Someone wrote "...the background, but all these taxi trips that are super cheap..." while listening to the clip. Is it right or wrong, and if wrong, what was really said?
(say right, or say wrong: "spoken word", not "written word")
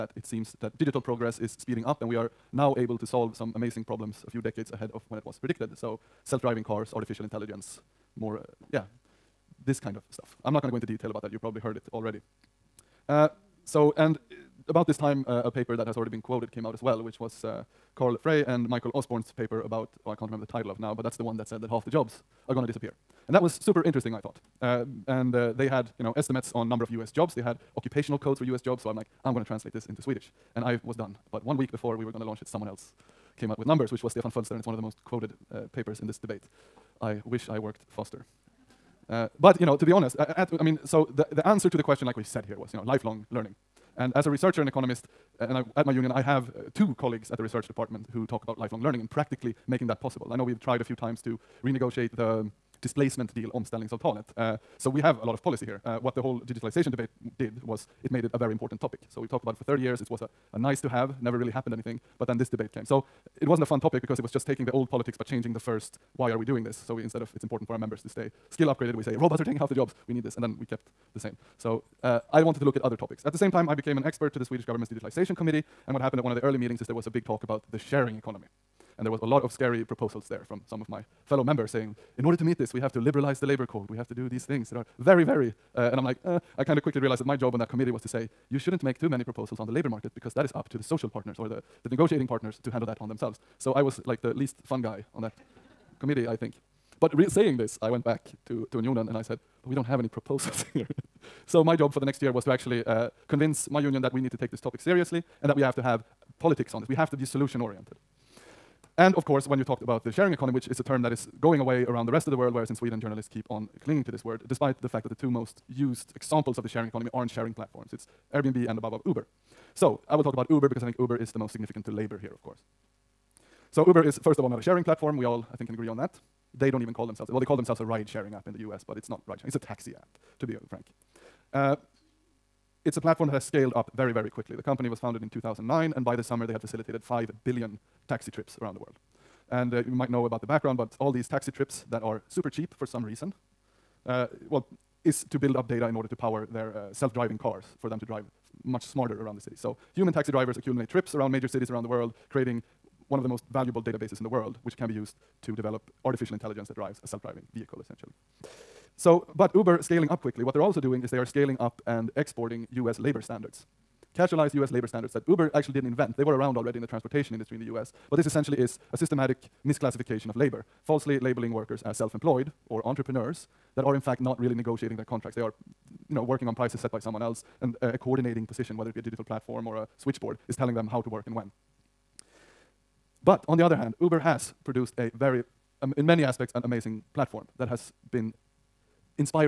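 right.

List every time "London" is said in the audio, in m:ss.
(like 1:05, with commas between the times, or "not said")
not said.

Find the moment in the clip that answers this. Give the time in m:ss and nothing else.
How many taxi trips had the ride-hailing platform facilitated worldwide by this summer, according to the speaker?
2:17.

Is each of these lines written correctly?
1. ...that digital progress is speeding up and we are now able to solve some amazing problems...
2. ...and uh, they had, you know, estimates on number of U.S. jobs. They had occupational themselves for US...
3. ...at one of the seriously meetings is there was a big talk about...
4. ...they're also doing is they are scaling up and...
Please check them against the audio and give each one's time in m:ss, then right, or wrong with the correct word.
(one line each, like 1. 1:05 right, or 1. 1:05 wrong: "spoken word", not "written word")
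1. 0:00 right
2. 0:25 wrong: "codes", not "themselves"
3. 1:16 wrong: "early", not "seriously"
4. 2:40 right.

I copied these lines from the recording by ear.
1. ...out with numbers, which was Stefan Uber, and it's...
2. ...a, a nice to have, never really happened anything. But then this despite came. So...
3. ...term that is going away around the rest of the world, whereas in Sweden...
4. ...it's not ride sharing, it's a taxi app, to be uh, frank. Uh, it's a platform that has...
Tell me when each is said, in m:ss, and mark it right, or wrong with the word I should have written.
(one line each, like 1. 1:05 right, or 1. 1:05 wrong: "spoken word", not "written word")
1. 0:33 wrong: "Fölster", not "Uber"
2. 1:00 wrong: "debate", not "despite"
3. 1:50 right
4. 2:08 right.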